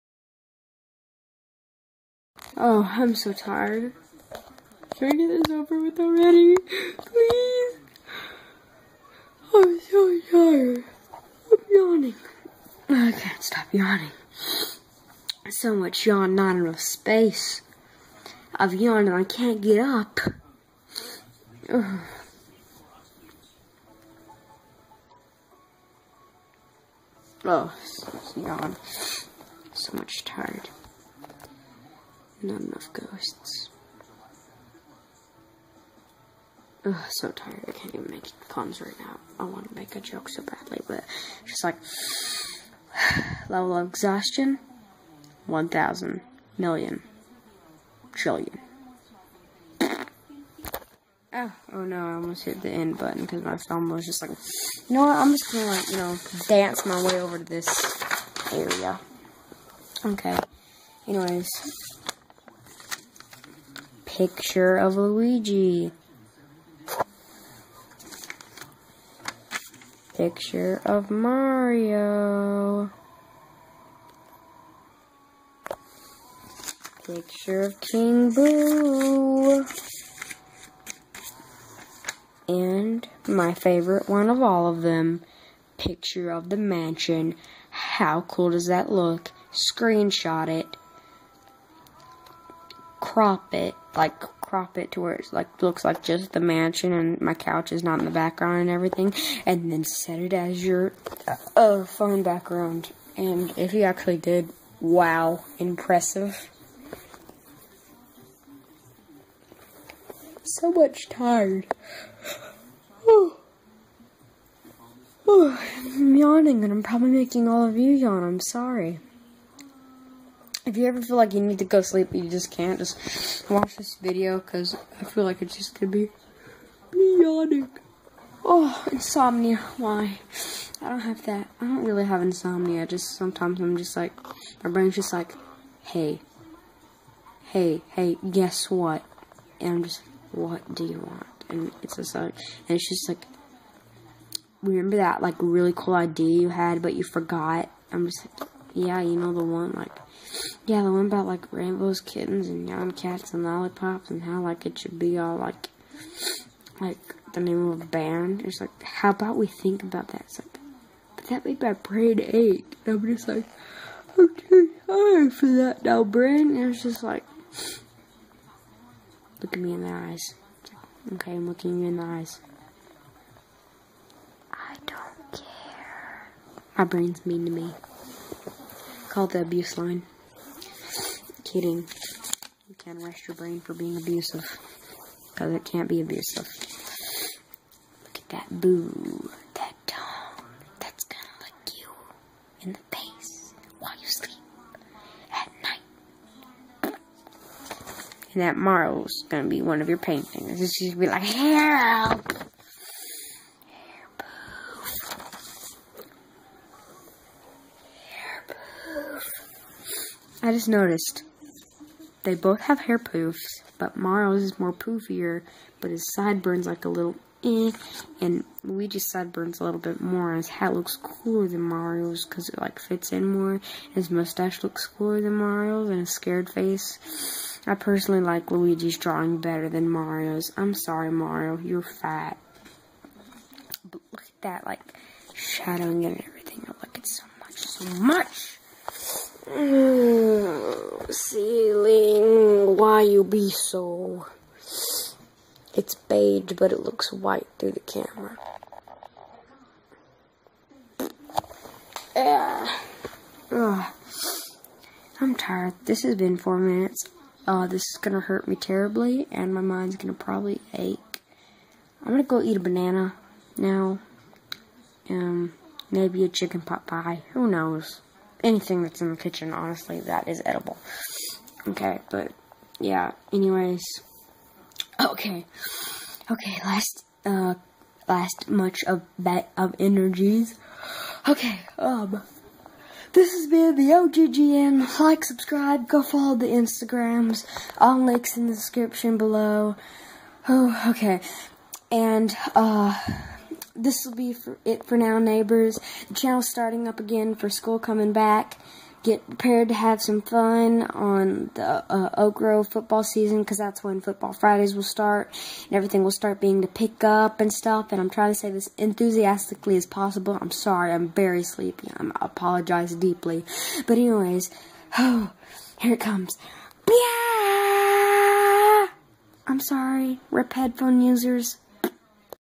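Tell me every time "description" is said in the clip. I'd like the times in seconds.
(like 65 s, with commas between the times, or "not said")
288 s.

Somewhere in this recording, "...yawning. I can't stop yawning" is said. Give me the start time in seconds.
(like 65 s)
11 s.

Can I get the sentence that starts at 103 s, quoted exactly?
And if you actually did, wow, impressive.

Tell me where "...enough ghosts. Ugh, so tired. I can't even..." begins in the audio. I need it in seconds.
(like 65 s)
32 s.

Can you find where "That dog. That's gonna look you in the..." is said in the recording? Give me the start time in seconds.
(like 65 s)
189 s.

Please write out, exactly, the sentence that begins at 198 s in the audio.
And that Marl's gonna be one of your paintings.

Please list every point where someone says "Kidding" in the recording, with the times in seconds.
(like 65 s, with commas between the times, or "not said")
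181 s.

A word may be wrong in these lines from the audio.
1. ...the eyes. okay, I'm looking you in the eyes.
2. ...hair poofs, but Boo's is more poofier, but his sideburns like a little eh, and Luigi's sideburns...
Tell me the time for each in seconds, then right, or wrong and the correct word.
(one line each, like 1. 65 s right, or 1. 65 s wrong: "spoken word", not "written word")
1. 169 s right
2. 212 s wrong: "Mario", not "Boo".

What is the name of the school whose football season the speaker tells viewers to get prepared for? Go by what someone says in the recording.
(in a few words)
Oak Grove.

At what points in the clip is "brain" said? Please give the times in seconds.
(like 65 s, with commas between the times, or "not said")
134 s, 161 s, 166 s, 176 s, 183 s.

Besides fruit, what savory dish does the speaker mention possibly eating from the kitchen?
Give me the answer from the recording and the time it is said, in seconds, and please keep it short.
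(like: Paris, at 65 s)
Chicken pot pie, at 266 s.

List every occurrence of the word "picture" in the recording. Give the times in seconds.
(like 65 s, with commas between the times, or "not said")
64 s, 70 s, 77 s, 85 s.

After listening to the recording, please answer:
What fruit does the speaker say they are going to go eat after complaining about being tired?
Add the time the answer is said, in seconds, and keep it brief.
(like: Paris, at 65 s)
Banana, at 262 s.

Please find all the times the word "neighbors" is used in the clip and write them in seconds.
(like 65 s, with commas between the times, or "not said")
295 s.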